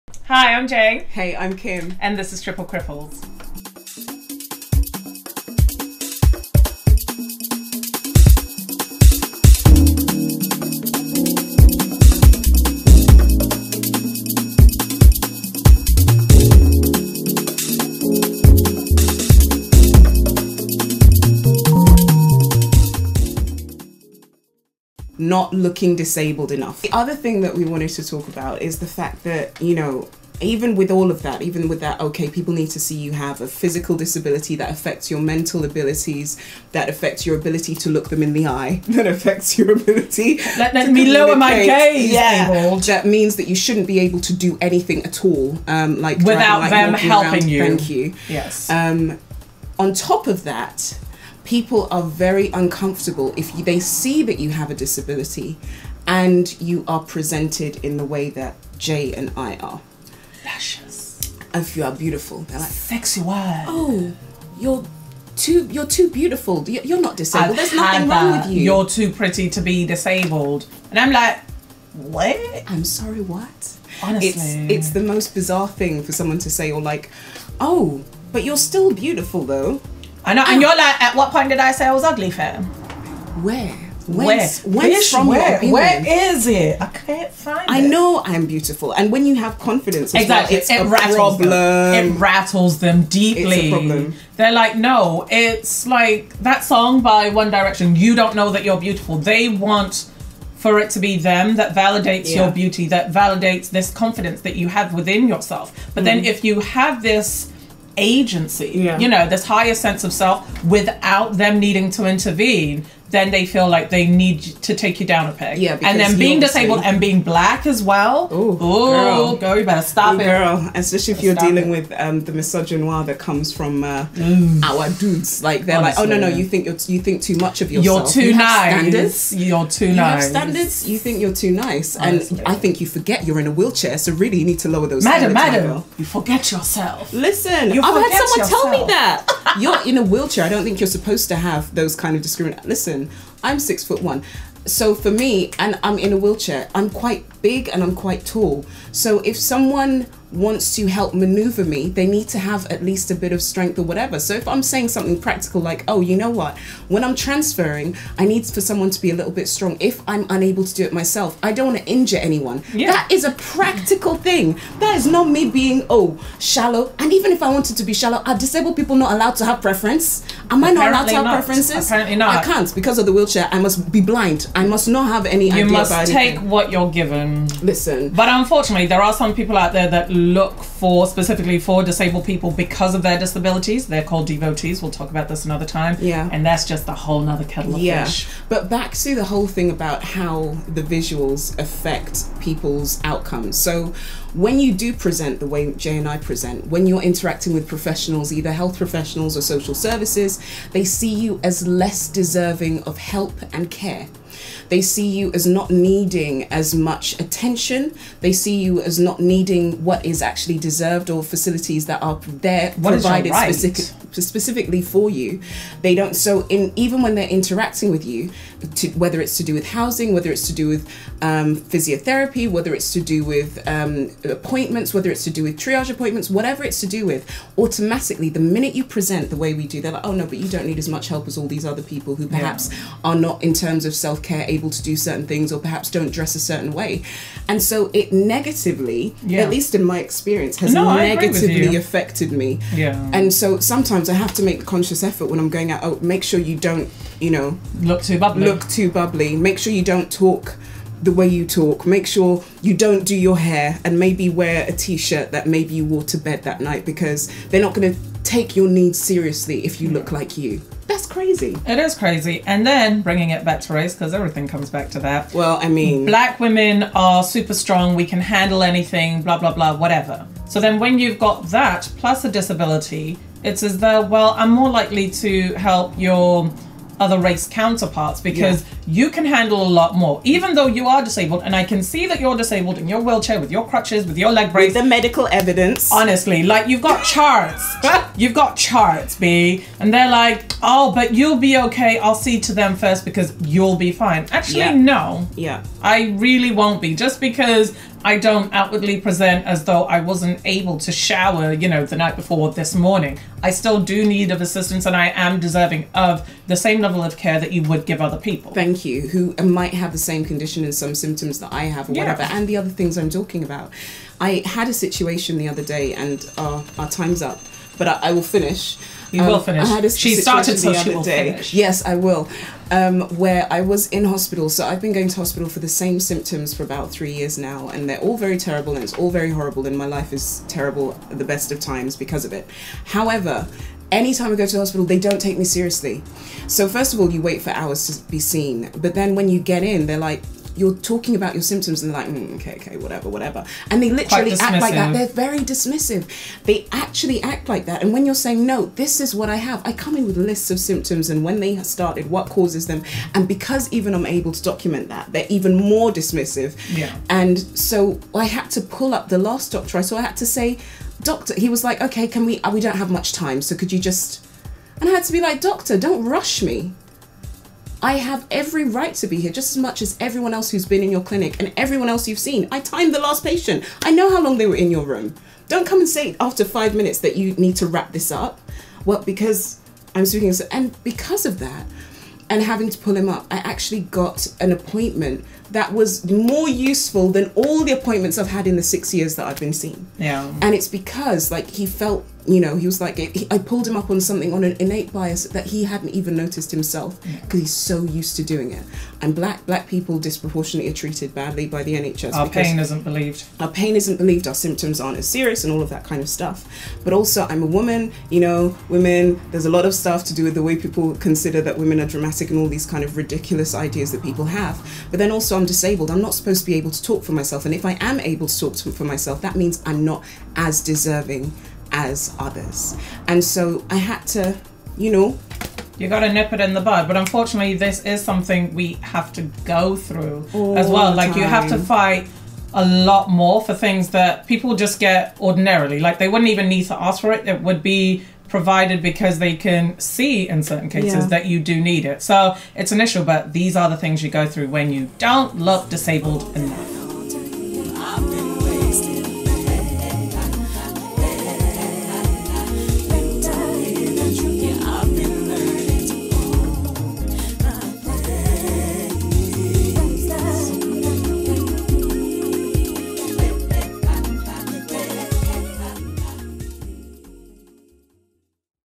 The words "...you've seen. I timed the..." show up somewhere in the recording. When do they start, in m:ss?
6:12.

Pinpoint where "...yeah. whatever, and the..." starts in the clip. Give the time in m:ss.
5:11.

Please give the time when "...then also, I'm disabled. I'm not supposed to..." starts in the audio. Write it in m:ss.
6:54.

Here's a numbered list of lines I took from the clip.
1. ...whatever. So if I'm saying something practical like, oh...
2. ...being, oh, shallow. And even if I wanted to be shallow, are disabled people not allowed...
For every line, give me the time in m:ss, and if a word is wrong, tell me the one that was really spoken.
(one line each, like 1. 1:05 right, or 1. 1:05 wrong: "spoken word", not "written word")
1. 2:33 right
2. 2:45 right.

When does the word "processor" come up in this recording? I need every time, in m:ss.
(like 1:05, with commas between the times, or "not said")
not said.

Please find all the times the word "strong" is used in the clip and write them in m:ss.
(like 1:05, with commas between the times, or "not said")
2:39, 4:27.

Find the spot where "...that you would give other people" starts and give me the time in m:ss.
5:07.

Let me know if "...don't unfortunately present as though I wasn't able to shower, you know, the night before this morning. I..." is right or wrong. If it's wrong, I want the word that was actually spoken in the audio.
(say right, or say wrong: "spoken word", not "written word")
wrong: "outwardly", not "unfortunately".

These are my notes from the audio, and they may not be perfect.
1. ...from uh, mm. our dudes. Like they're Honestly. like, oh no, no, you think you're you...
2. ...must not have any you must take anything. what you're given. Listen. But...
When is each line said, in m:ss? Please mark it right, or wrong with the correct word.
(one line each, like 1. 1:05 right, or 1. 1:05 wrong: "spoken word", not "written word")
1. 2:03 right
2. 2:54 right.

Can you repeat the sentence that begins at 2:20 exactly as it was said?
I don't think you're supposed to have those kind of discrimination.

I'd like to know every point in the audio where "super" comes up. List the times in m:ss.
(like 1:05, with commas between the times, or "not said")
4:27.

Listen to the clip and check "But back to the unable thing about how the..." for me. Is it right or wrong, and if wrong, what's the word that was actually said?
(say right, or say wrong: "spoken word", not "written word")
wrong: "whole", not "unable".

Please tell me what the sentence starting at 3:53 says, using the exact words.
are not, in terms of self care, able to do certain things or perhaps don't dress a certain way.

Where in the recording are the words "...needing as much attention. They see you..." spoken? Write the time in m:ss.
3:25.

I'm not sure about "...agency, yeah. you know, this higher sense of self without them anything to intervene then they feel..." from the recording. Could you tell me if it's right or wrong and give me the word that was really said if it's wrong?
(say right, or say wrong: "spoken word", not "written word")
wrong: "needing", not "anything".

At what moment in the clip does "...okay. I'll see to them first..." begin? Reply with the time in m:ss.
4:51.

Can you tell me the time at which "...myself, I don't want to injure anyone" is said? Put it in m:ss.
2:40.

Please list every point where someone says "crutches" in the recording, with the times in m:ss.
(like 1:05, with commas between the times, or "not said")
4:43.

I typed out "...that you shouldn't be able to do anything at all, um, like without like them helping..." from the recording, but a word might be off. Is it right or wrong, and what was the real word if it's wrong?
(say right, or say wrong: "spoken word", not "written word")
right.